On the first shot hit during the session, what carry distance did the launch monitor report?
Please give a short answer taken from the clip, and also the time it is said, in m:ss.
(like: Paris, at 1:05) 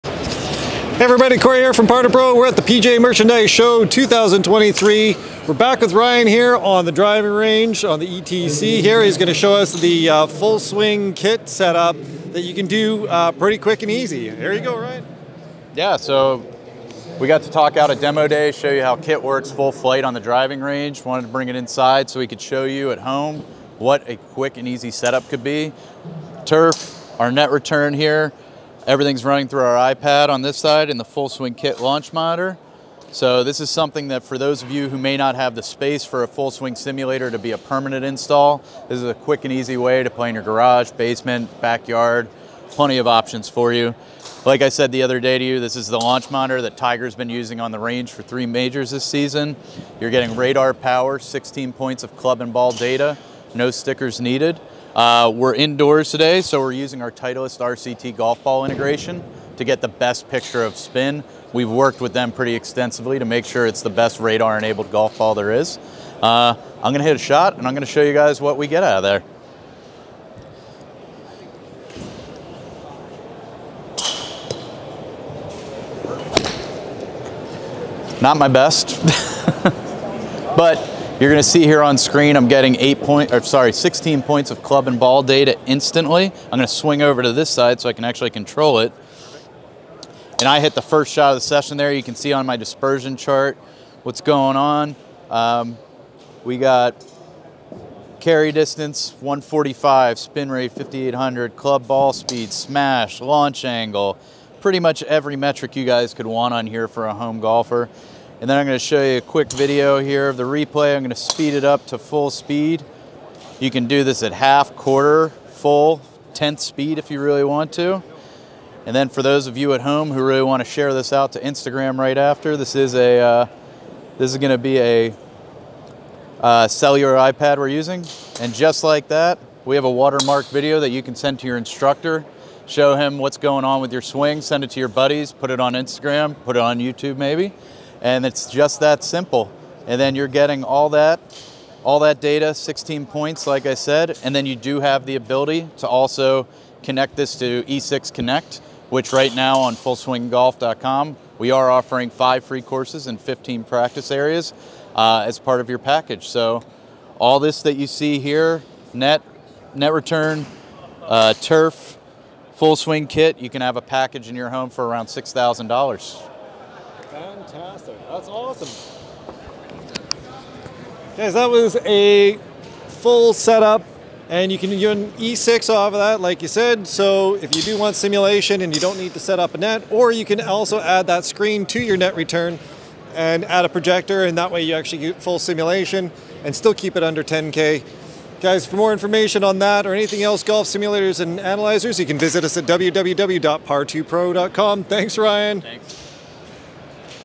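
145, at 1:39.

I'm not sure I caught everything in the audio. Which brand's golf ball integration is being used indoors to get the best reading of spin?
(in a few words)
Titleist RCT.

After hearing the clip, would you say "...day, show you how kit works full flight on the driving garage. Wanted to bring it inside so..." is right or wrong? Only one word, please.
wrong.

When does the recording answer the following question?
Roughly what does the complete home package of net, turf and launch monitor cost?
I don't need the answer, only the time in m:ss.
2:45.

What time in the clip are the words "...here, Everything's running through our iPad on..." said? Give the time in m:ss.
0:27.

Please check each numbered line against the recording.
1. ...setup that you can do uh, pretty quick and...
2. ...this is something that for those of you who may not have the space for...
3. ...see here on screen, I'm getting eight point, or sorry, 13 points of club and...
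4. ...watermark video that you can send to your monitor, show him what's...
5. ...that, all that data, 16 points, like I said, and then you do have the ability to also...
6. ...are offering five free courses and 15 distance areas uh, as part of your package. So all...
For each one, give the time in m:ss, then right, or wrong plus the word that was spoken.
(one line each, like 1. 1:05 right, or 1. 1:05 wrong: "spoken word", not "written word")
1. 0:11 right
2. 0:33 right
3. 1:21 wrong: "16", not "13"
4. 2:09 wrong: "instructor", not "monitor"
5. 2:20 right
6. 2:31 wrong: "practice", not "distance".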